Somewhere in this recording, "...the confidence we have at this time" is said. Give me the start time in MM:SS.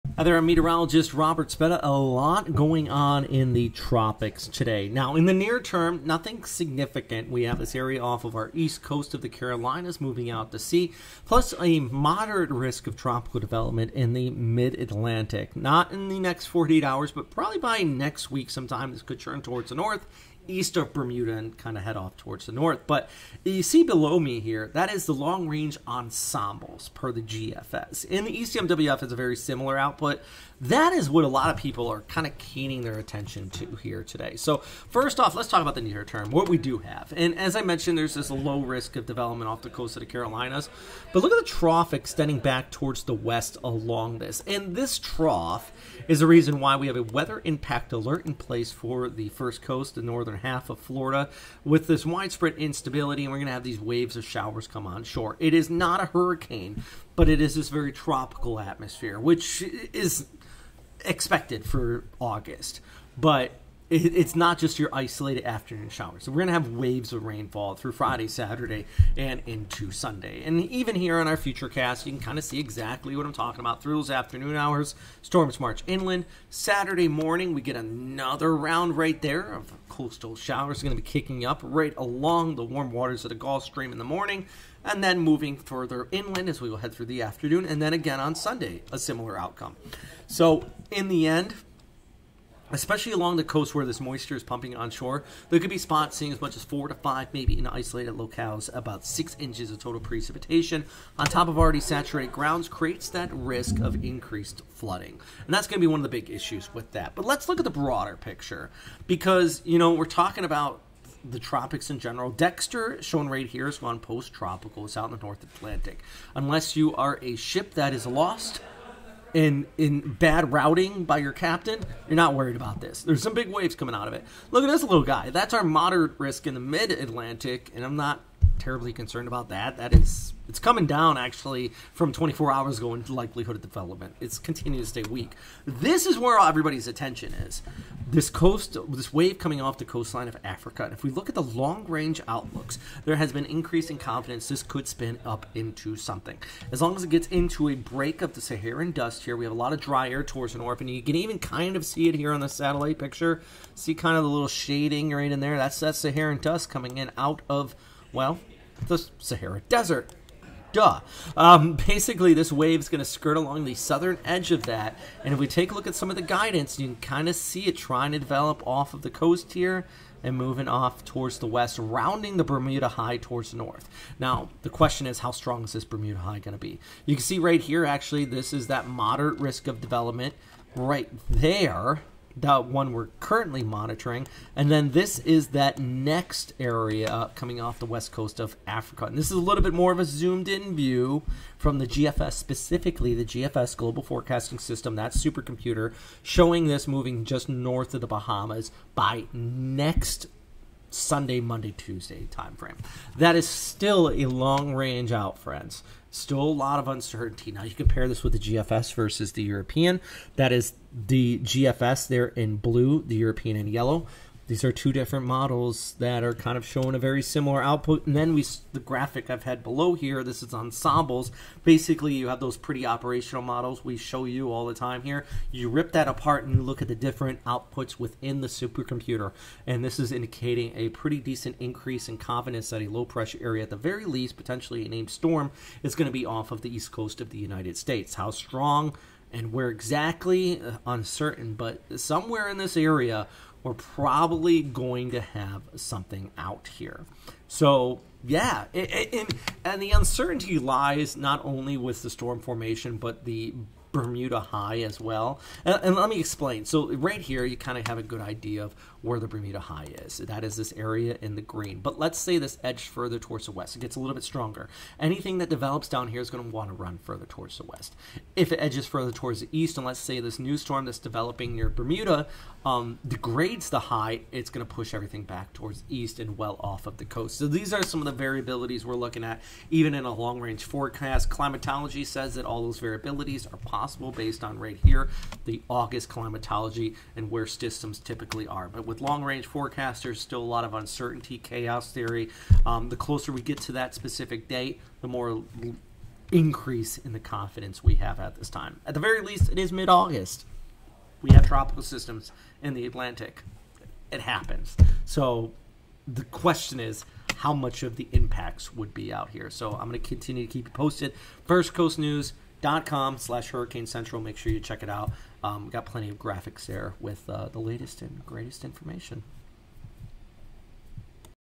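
04:57.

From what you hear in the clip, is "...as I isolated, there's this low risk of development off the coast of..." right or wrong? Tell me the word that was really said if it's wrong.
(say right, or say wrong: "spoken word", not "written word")
wrong: "mentioned", not "isolated".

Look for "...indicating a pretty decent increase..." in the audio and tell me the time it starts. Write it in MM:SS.
03:50.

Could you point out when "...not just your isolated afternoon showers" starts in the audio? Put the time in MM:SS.
01:04.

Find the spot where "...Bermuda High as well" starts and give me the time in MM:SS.
04:13.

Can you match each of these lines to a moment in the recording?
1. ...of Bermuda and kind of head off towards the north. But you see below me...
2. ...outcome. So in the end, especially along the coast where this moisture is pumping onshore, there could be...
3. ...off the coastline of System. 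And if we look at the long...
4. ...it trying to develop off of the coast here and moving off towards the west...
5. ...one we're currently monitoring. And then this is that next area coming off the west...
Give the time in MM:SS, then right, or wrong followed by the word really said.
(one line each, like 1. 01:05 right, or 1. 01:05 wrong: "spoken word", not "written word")
1. 00:20 right
2. 01:29 right
3. 02:19 wrong: "Africa", not "System"
4. 02:47 right
5. 03:02 right.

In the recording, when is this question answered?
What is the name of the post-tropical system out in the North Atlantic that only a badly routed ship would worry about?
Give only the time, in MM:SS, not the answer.
01:52.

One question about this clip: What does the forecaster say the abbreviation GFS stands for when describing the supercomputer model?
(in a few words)
Global Forecasting System.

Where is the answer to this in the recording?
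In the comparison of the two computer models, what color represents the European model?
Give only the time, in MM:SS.
03:33.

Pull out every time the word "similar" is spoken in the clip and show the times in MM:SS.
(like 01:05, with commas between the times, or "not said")
00:29, 01:28, 03:37.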